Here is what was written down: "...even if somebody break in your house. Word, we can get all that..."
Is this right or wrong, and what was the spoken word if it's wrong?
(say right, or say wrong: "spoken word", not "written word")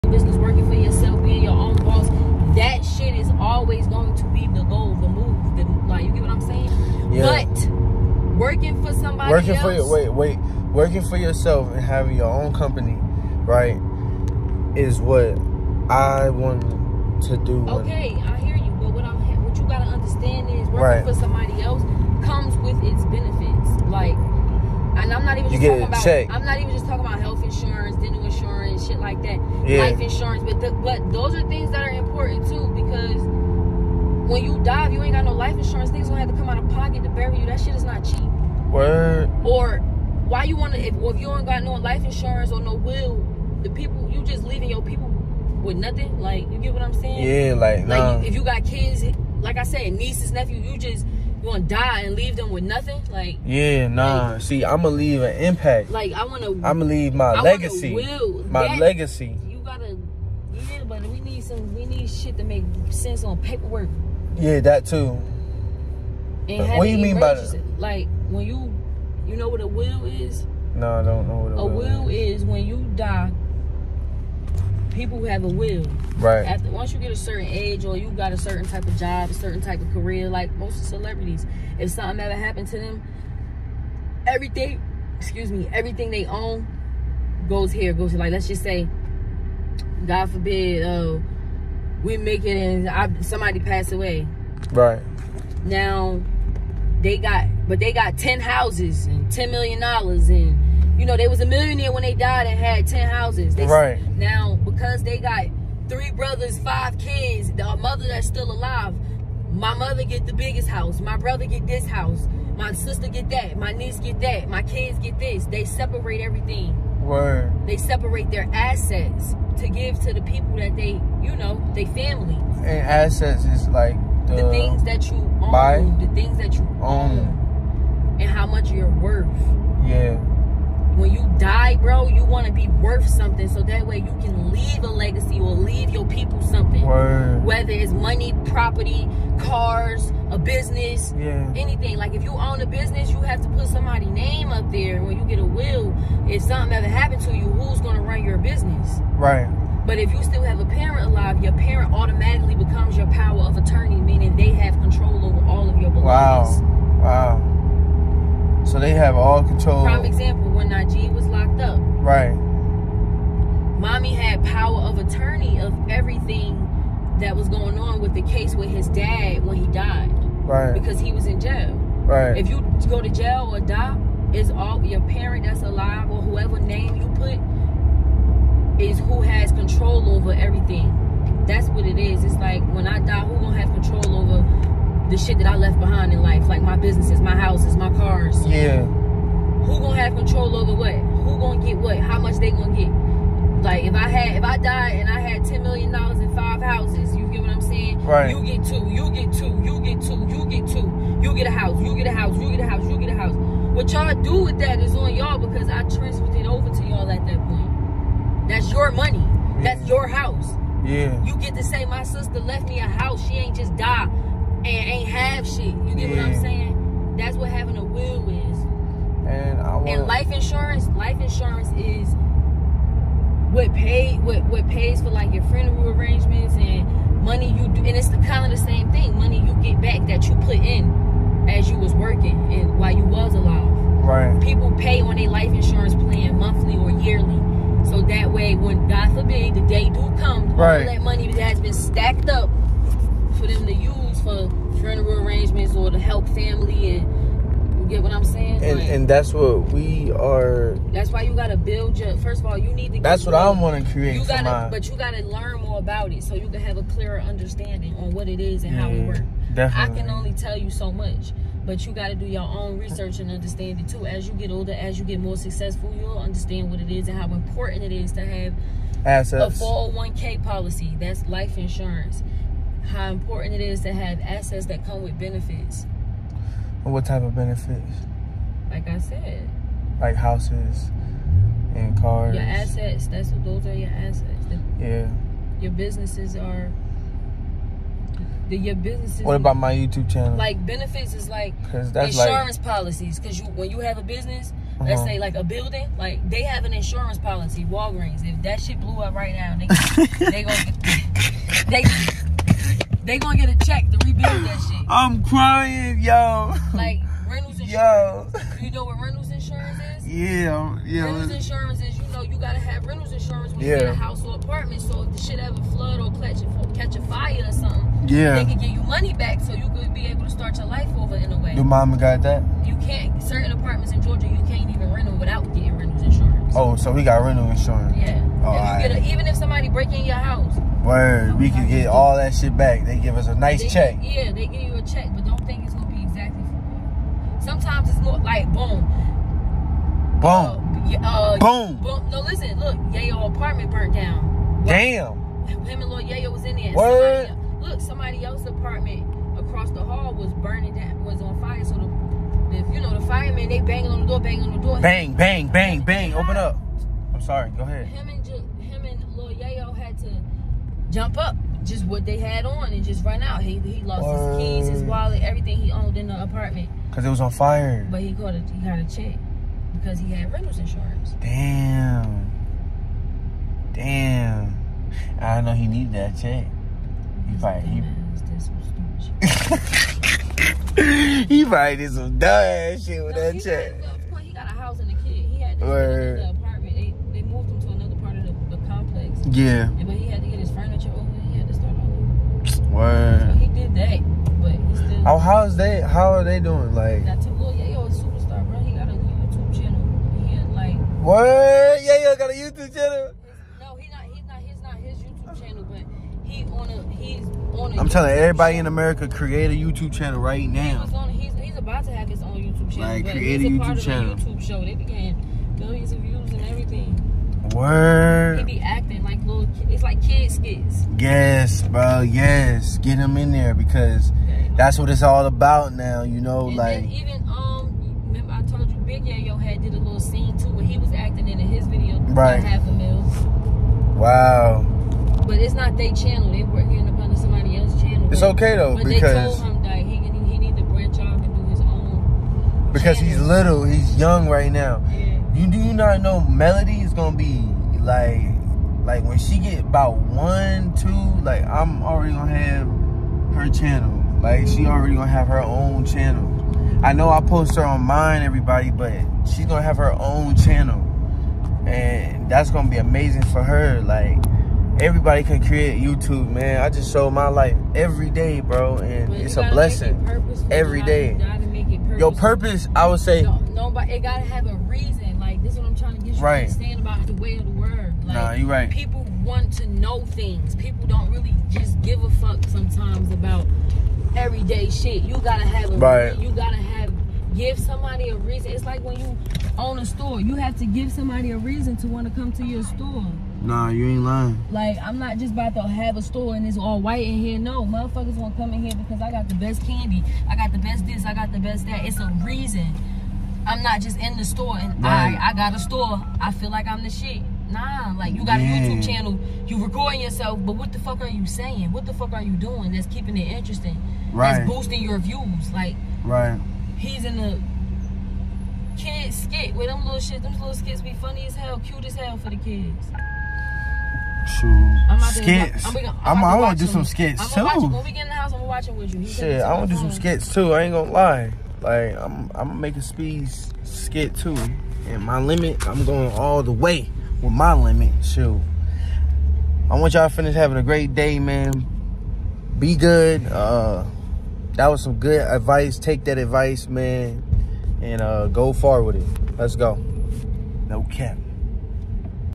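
right.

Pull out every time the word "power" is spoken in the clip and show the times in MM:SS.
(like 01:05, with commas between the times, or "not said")
02:33, 02:44.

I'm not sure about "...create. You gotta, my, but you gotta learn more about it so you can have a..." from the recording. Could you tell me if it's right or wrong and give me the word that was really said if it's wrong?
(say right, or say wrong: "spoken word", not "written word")
right.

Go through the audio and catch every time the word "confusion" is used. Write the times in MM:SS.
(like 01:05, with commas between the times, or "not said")
not said.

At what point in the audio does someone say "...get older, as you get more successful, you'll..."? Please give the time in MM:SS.
04:24.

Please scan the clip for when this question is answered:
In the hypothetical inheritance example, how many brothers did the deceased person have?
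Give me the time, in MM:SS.
01:45.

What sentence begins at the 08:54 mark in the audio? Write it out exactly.
And my limit, I'm going all the way with my limit.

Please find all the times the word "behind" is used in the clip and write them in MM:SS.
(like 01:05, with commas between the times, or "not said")
03:05.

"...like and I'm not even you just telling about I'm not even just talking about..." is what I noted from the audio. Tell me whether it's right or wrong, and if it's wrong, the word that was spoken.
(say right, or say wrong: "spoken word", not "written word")
wrong: "talking", not "telling".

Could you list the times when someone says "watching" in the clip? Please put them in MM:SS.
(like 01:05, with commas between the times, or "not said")
08:48.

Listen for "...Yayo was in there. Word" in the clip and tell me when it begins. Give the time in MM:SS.
05:46.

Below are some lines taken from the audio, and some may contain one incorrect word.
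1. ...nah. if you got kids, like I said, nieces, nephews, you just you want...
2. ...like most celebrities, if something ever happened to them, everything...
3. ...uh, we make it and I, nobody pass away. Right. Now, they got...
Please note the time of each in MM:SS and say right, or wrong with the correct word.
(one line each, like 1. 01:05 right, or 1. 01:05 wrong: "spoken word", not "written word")
1. 00:47 right
2. 01:20 right
3. 01:30 wrong: "somebody", not "nobody".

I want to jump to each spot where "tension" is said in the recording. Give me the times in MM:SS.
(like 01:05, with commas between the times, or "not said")
not said.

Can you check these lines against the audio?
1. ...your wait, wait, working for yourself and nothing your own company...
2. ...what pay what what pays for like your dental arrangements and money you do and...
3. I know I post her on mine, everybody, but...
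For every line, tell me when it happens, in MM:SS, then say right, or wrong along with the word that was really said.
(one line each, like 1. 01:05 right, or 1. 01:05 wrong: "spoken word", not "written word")
1. 00:09 wrong: "having", not "nothing"
2. 03:43 wrong: "funeral", not "dental"
3. 07:36 right.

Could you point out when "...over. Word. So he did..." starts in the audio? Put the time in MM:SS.
06:31.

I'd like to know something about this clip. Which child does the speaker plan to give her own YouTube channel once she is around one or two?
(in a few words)
Melody.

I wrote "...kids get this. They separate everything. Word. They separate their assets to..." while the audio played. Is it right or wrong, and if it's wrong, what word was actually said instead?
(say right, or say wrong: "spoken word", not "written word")
right.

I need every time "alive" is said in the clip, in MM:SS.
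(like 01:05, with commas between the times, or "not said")
01:48, 02:31, 02:55, 03:53.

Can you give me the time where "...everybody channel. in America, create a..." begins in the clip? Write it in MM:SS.
06:48.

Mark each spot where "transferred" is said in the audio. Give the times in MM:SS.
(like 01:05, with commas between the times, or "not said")
03:25.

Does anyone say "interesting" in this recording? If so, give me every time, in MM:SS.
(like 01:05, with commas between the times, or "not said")
08:33.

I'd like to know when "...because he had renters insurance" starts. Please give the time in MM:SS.
06:09.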